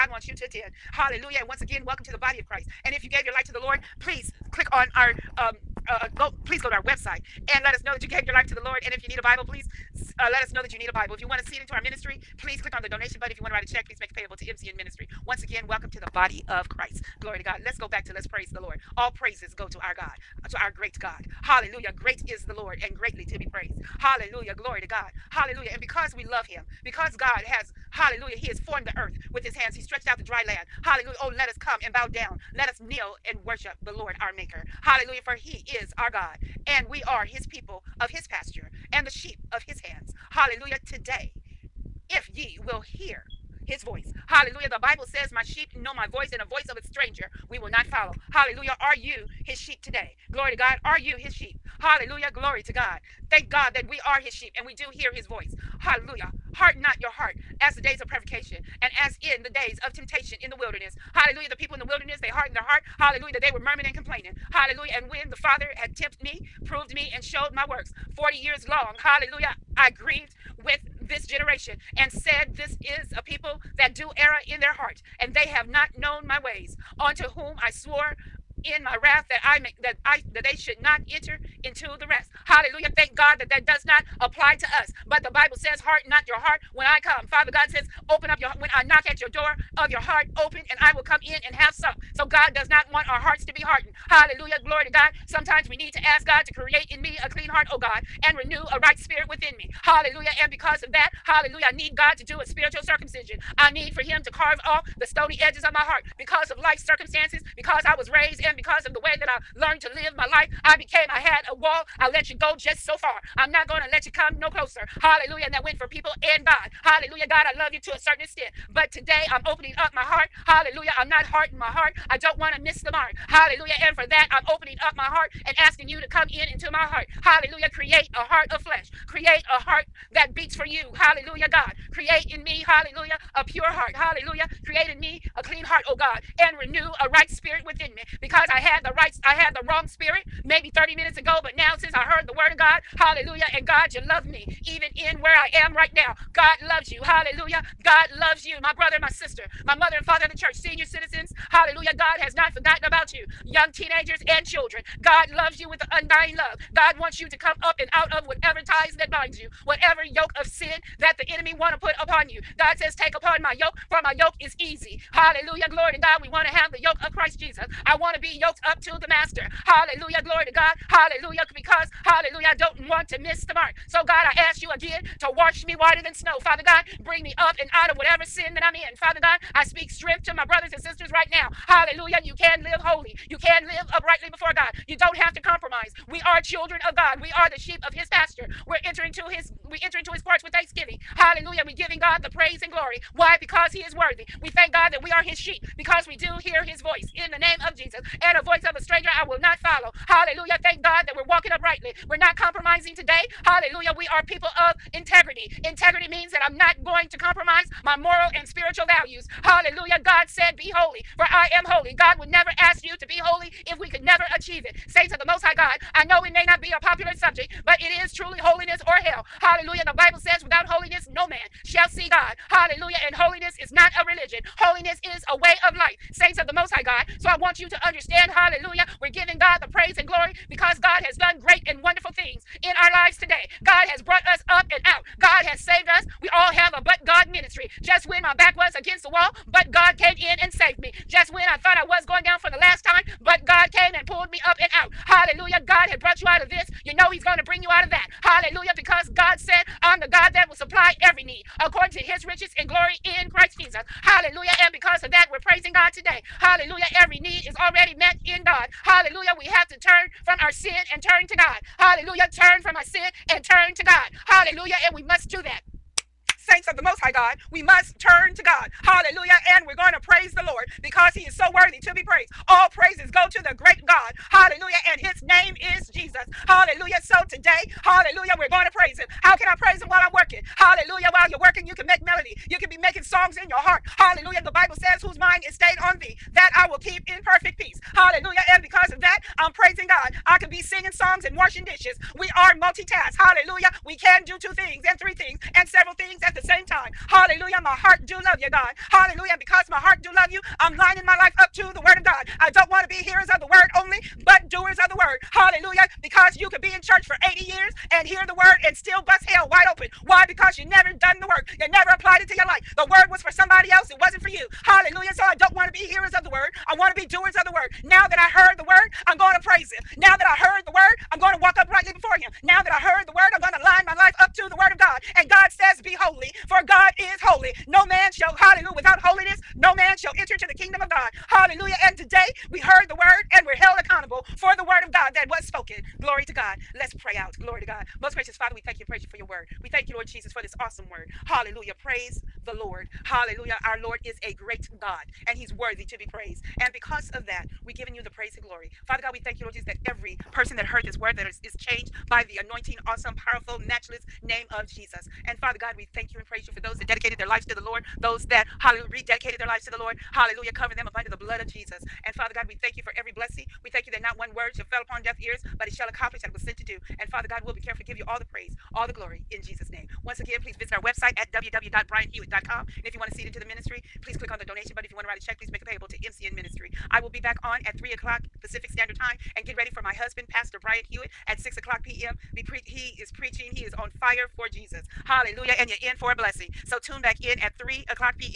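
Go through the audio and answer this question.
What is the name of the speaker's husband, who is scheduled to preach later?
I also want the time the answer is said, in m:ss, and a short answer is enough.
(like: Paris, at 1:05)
Pastor Bryant Hewitt, at 6:20.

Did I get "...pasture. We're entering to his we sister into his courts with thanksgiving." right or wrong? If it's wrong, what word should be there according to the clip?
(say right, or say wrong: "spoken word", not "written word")
wrong: "enter", not "sister".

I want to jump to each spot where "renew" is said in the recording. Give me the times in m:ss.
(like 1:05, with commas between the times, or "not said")
1:38, 2:16.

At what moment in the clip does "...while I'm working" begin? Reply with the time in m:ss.
4:39.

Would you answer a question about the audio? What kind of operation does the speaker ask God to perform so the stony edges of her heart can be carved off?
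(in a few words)
spiritual circumcision.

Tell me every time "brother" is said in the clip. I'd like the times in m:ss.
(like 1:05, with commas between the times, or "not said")
2:28, 3:00.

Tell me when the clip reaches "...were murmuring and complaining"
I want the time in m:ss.
1:03.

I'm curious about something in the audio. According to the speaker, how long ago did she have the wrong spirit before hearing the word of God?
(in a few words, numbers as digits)
30 minutes.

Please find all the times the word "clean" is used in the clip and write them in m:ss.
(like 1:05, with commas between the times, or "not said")
1:37, 2:15.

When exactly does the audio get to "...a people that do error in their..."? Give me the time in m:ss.
1:13.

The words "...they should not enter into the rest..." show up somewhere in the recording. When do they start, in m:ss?
1:20.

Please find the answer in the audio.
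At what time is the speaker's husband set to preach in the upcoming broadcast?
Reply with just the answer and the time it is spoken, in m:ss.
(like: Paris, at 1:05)
6 p.m., at 6:21.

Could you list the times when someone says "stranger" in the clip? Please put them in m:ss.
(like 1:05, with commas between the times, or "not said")
0:46, 3:18.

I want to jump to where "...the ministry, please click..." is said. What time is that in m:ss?
6:13.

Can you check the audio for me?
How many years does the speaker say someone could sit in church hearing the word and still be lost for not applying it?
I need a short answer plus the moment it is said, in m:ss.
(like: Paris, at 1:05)
80 years, at 5:07.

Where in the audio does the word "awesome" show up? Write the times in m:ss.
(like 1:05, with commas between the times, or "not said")
5:40, 5:52.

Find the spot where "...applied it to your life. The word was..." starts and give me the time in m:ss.
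5:11.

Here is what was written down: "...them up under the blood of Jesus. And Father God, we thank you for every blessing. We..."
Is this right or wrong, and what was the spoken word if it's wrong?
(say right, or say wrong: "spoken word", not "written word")
right.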